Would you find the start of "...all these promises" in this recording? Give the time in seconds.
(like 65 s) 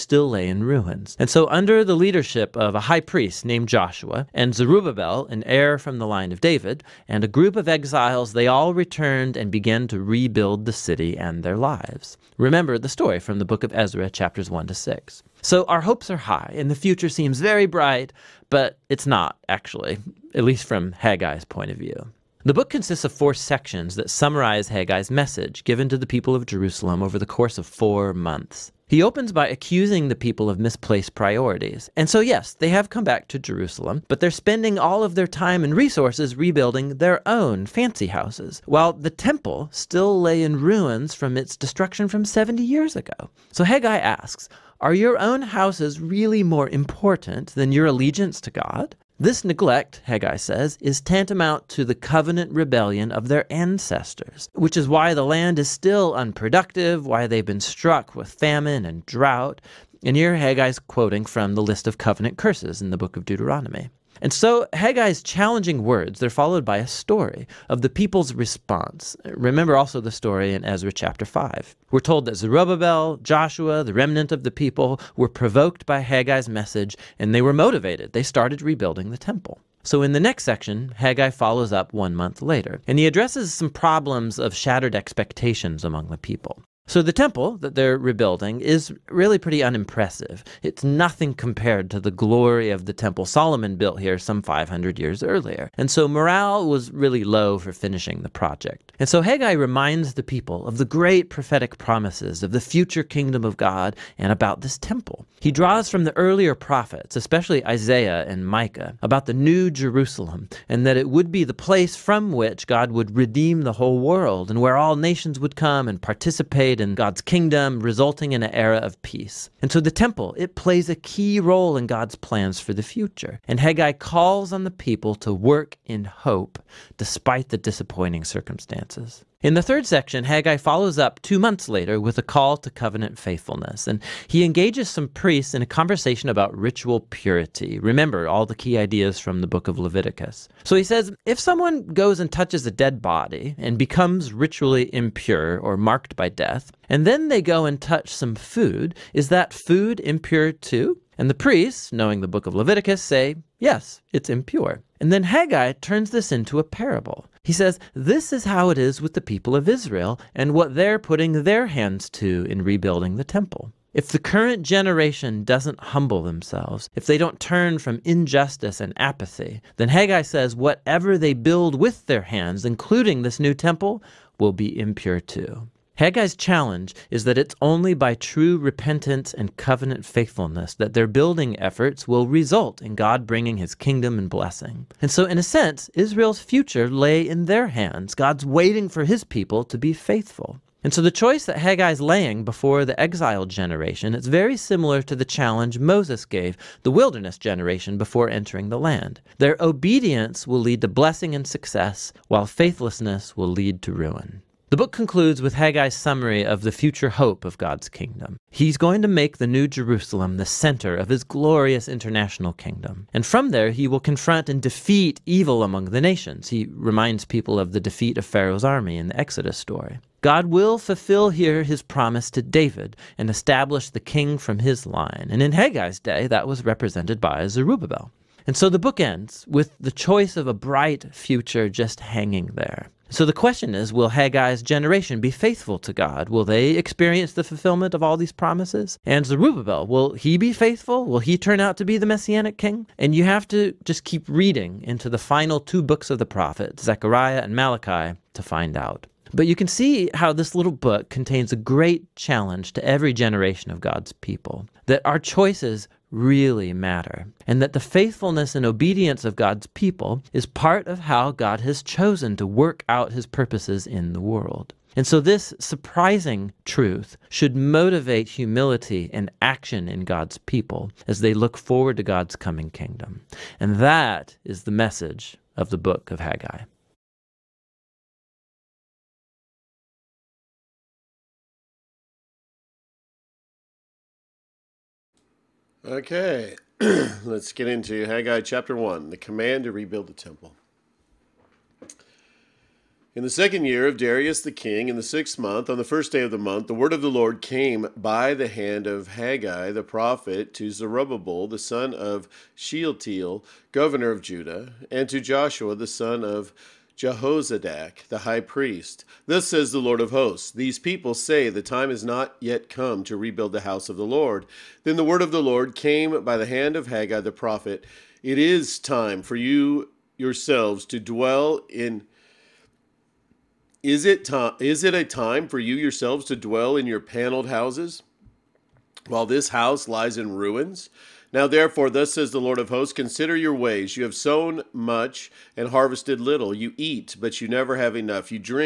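238 s.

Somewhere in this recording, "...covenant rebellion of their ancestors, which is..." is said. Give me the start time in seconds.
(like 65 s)
51 s.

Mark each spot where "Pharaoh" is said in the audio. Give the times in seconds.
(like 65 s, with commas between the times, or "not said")
218 s.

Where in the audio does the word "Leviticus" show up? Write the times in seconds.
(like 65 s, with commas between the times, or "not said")
139 s, 152 s.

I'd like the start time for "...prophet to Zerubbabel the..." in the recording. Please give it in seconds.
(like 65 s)
299 s.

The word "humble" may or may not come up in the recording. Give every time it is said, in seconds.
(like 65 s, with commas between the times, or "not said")
165 s.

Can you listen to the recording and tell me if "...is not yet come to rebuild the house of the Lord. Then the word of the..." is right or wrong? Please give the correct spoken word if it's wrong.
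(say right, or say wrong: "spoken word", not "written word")
right.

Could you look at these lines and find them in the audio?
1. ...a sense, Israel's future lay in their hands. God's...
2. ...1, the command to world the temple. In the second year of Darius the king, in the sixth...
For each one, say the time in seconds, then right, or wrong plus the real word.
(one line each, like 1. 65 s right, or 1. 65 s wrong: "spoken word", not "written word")
1. 185 s right
2. 288 s wrong: "rebuild", not "world".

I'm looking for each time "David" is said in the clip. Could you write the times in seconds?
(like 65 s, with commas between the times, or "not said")
6 s, 222 s.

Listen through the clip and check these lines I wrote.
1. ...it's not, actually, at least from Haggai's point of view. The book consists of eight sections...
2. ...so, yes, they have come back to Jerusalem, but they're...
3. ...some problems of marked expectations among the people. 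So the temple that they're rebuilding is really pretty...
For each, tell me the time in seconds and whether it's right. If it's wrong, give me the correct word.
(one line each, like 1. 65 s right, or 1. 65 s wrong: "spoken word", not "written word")
1. 18 s wrong: "four", not "eight"
2. 32 s right
3. 83 s wrong: "shattered", not "marked".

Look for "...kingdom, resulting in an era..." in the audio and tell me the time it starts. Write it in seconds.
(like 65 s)
117 s.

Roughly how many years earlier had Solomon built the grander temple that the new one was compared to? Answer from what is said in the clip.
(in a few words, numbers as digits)
500.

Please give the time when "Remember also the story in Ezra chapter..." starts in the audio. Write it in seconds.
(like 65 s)
69 s.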